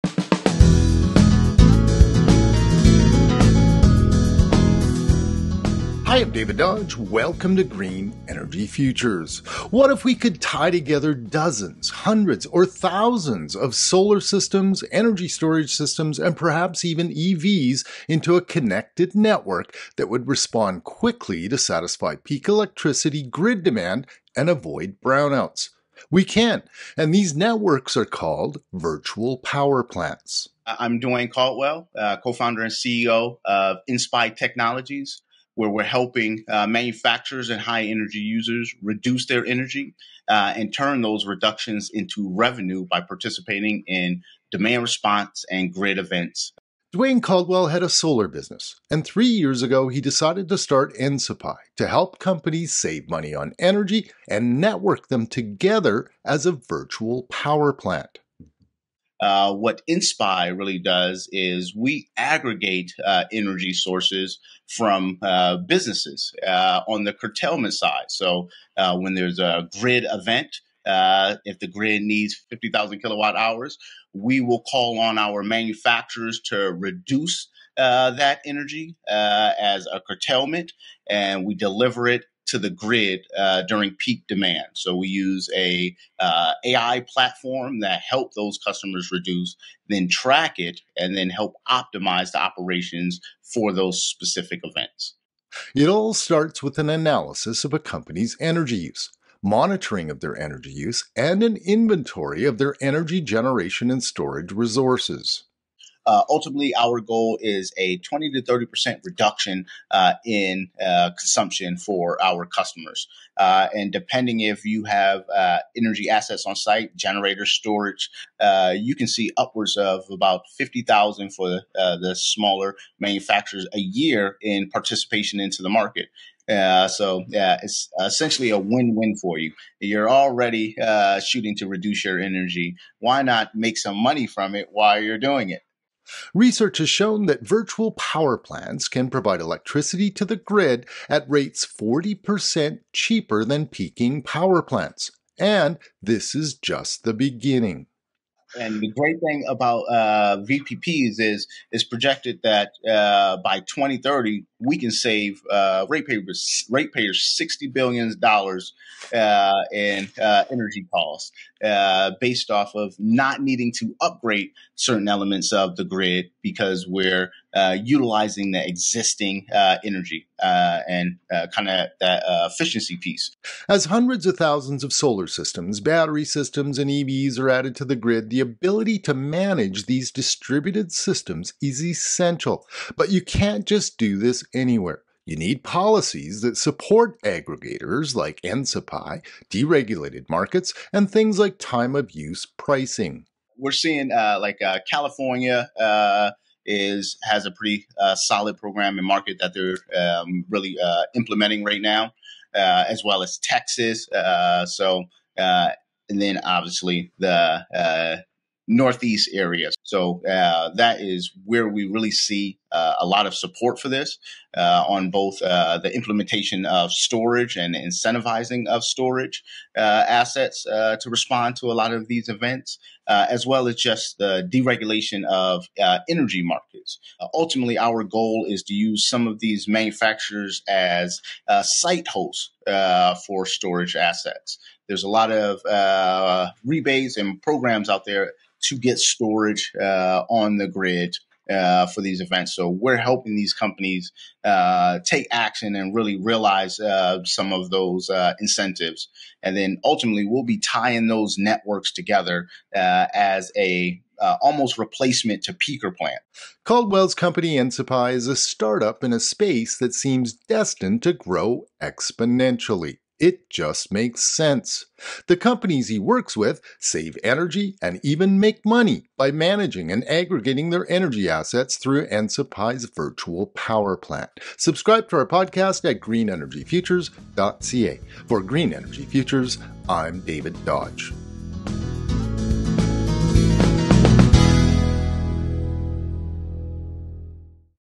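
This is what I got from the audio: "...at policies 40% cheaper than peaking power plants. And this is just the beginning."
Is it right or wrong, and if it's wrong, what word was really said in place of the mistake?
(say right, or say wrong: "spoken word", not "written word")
wrong: "rates", not "policies".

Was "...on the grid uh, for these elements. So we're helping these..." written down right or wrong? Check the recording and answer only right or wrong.
wrong.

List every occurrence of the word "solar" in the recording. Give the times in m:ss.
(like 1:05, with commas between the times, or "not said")
0:13, 0:47, 2:54.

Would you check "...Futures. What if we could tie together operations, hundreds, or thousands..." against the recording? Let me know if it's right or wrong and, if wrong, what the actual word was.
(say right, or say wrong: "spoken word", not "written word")
wrong: "dozens", not "operations".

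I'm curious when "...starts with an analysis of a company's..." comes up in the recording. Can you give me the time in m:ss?
1:36.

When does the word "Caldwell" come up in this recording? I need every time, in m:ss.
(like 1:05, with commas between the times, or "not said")
0:31, 0:47, 4:16.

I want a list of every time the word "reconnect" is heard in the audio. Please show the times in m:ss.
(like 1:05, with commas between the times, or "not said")
not said.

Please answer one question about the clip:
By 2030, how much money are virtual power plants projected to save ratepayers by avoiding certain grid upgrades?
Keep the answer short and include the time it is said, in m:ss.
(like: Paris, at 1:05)
$60 billion, at 2:37.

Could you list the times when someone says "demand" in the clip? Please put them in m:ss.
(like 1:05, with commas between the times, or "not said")
0:23, 0:44, 1:24.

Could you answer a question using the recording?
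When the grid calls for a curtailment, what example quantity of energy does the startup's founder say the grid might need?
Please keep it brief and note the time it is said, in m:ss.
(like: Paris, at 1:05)
50,000 kilowatt hours, at 1:12.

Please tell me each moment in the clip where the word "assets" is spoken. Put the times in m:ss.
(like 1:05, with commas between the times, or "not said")
1:56, 3:40, 3:53, 4:31.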